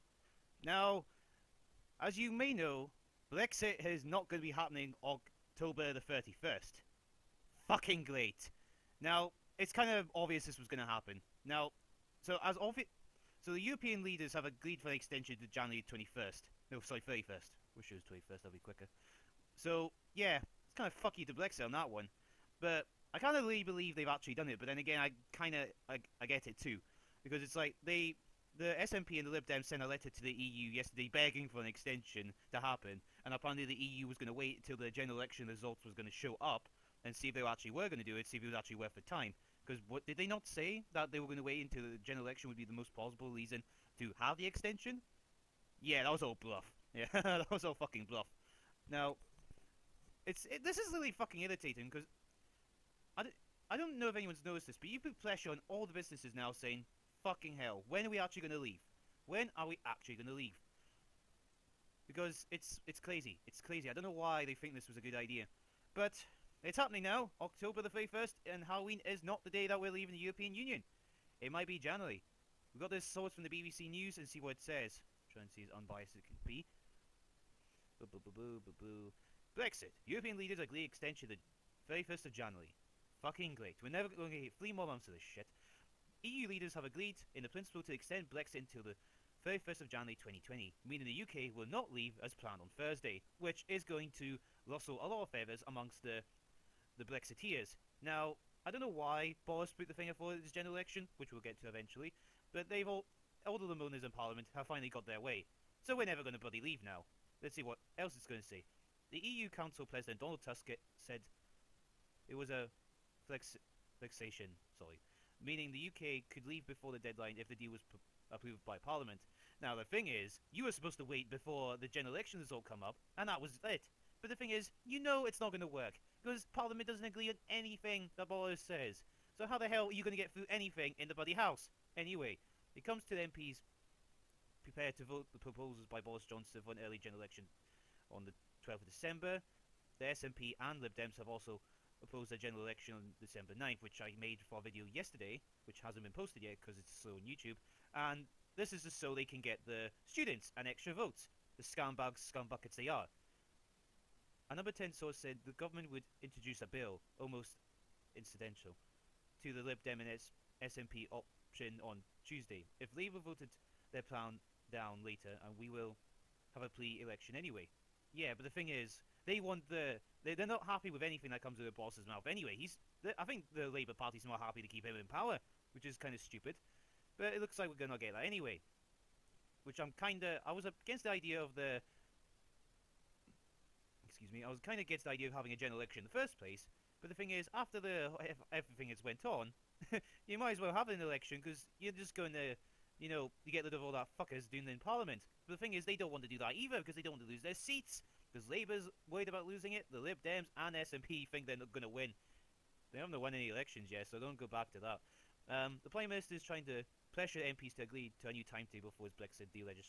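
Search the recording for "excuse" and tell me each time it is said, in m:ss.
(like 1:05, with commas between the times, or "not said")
3:04.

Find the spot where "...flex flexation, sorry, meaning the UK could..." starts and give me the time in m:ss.
1:53.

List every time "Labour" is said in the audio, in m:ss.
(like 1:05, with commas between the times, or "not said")
2:42, 2:53, 3:18.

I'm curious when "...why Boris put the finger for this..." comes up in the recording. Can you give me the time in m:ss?
1:38.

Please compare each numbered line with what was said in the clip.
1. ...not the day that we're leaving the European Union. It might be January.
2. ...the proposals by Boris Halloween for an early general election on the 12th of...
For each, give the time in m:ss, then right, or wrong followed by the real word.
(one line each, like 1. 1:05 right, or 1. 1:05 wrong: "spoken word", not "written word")
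1. 1:09 right
2. 2:15 wrong: "Johnson", not "Halloween".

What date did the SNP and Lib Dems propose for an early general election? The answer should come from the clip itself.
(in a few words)
December 9.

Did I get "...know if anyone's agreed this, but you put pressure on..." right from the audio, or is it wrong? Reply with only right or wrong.
wrong.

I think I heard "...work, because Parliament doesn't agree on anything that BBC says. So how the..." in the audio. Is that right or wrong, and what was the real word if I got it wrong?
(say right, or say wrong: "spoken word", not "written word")
wrong: "Boris", not "BBC".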